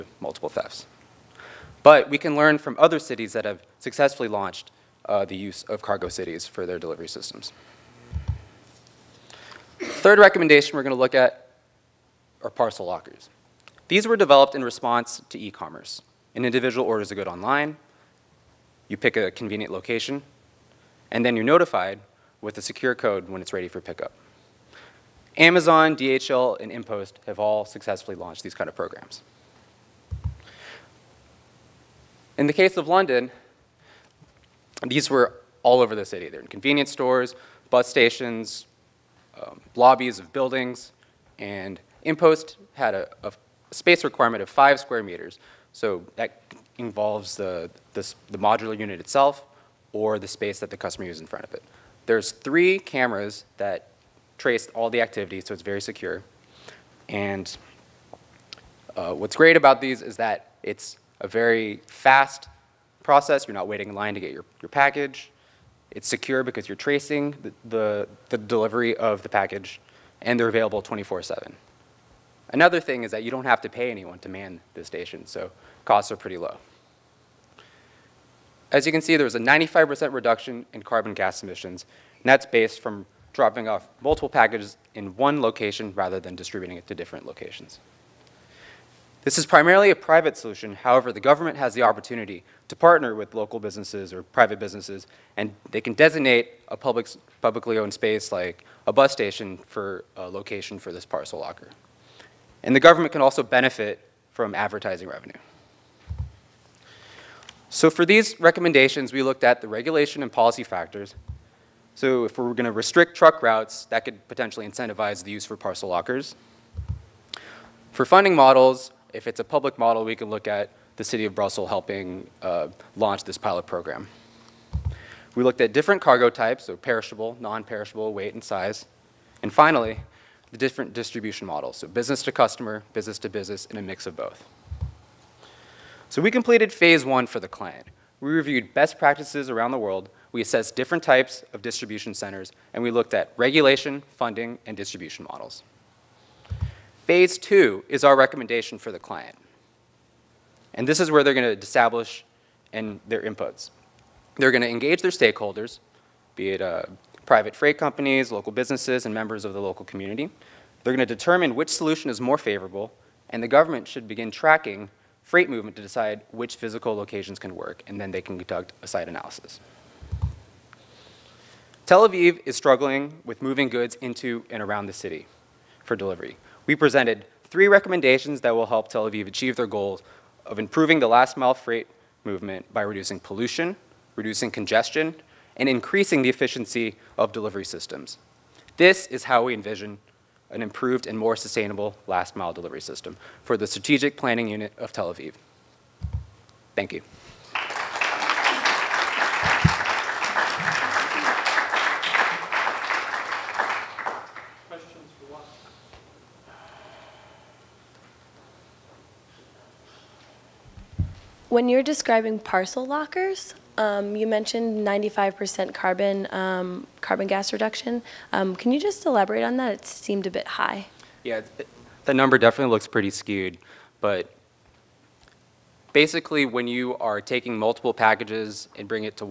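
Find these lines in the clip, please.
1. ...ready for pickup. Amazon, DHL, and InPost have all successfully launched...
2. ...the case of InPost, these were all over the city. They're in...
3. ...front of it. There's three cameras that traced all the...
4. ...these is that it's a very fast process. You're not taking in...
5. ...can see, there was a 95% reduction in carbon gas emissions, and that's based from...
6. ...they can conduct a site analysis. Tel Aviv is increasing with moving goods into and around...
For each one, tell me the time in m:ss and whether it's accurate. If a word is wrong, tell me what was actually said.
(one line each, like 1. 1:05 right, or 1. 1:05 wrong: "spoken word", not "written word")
1. 0:23 right
2. 0:32 wrong: "London", not "InPost"
3. 0:51 right
4. 0:59 wrong: "waiting", not "taking"
5. 1:18 right
6. 2:48 wrong: "struggling", not "increasing".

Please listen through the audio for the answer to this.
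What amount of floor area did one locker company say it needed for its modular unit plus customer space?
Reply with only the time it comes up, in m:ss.
0:44.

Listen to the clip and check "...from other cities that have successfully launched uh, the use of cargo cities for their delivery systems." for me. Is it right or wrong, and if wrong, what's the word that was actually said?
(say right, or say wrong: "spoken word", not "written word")
right.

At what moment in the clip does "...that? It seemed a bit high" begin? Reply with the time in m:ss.
3:39.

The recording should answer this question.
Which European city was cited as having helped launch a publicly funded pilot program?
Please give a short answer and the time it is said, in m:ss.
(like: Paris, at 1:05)
Brussels, at 2:01.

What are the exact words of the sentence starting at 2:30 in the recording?
And this is where they're gonna establish and their inputs.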